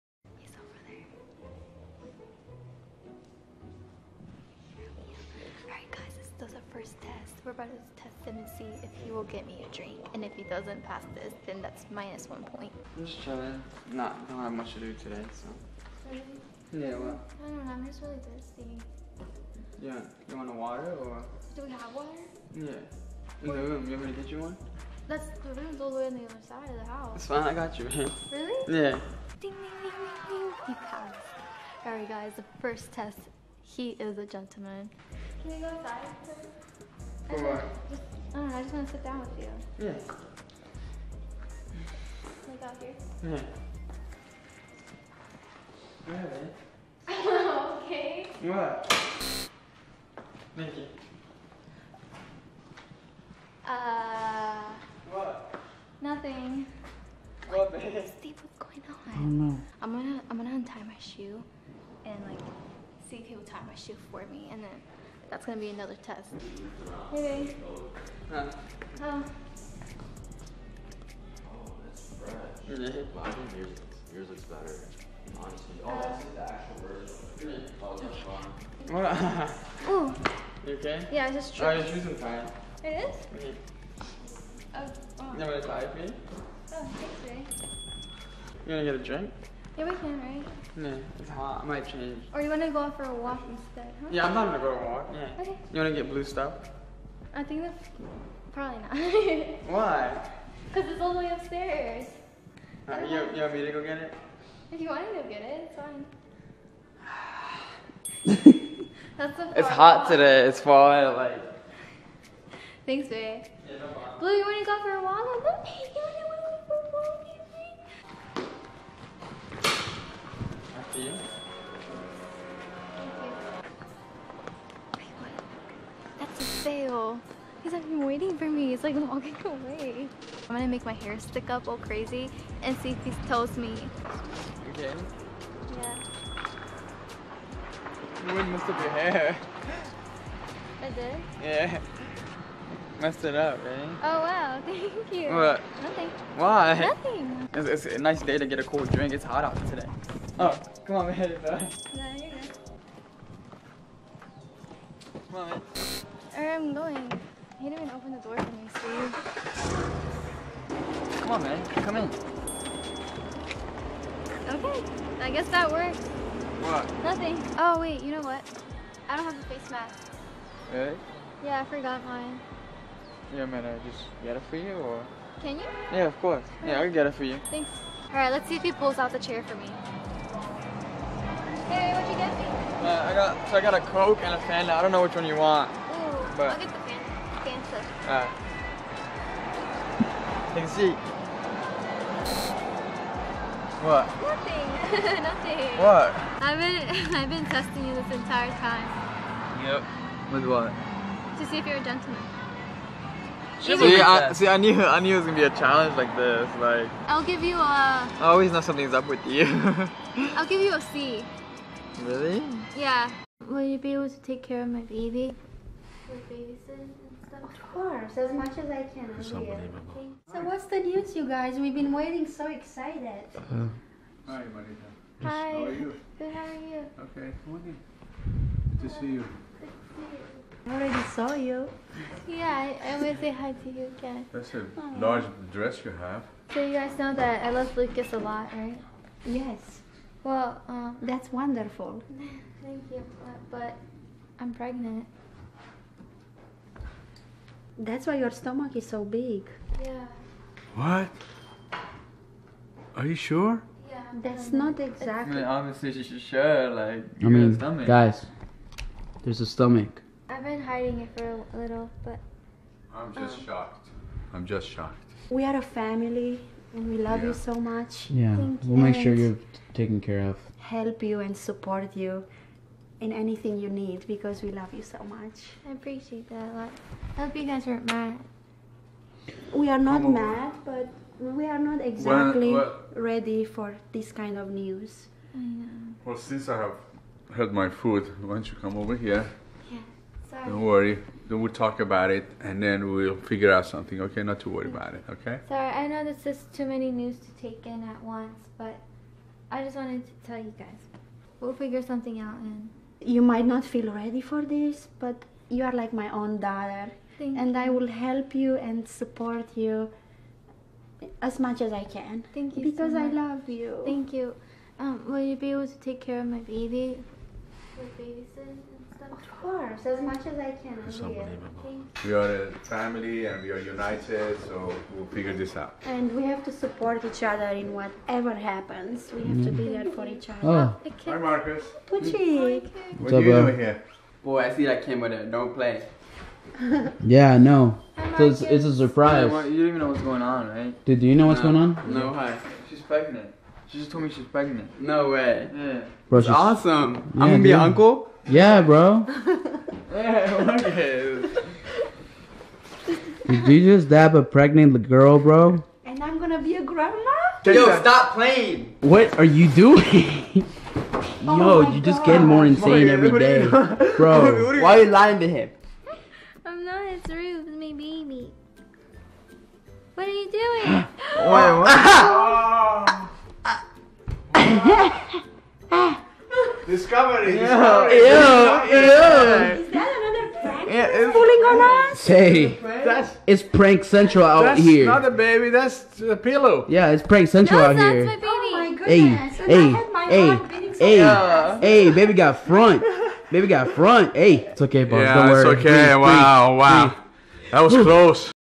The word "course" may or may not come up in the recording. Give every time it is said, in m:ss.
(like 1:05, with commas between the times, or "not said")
2:56, 3:37, 5:19.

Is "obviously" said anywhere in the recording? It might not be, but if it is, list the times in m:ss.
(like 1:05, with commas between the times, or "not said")
4:15.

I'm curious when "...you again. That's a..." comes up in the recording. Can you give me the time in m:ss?
3:53.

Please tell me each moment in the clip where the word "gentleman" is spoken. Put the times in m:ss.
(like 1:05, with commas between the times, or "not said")
0:34, 3:21.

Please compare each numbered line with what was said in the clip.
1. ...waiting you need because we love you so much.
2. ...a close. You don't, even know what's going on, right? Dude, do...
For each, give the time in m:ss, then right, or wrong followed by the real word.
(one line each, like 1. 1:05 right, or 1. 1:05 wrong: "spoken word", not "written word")
1. 4:33 wrong: "anything", not "waiting"
2. 5:38 wrong: "surprise", not "close".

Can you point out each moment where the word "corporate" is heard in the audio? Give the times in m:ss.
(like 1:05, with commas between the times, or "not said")
not said.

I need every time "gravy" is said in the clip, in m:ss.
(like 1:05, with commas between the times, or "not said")
not said.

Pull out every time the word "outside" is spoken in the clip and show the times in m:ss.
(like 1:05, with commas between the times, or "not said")
0:35.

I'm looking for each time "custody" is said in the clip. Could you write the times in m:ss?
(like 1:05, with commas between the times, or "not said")
not said.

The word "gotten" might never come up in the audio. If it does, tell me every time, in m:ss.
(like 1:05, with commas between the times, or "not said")
not said.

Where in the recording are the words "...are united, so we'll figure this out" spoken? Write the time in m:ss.
5:23.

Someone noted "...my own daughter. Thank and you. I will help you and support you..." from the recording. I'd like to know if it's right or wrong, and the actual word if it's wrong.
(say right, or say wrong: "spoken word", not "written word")
right.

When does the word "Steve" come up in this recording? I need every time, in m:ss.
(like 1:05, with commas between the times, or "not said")
0:58, 2:38.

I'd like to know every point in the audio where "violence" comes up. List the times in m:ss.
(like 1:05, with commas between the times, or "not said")
not said.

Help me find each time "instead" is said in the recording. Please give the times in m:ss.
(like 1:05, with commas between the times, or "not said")
1:33.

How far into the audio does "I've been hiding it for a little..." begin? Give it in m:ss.
4:20.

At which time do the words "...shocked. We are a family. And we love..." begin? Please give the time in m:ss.
4:24.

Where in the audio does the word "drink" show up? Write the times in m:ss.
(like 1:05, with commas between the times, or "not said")
0:09, 1:28, 2:28.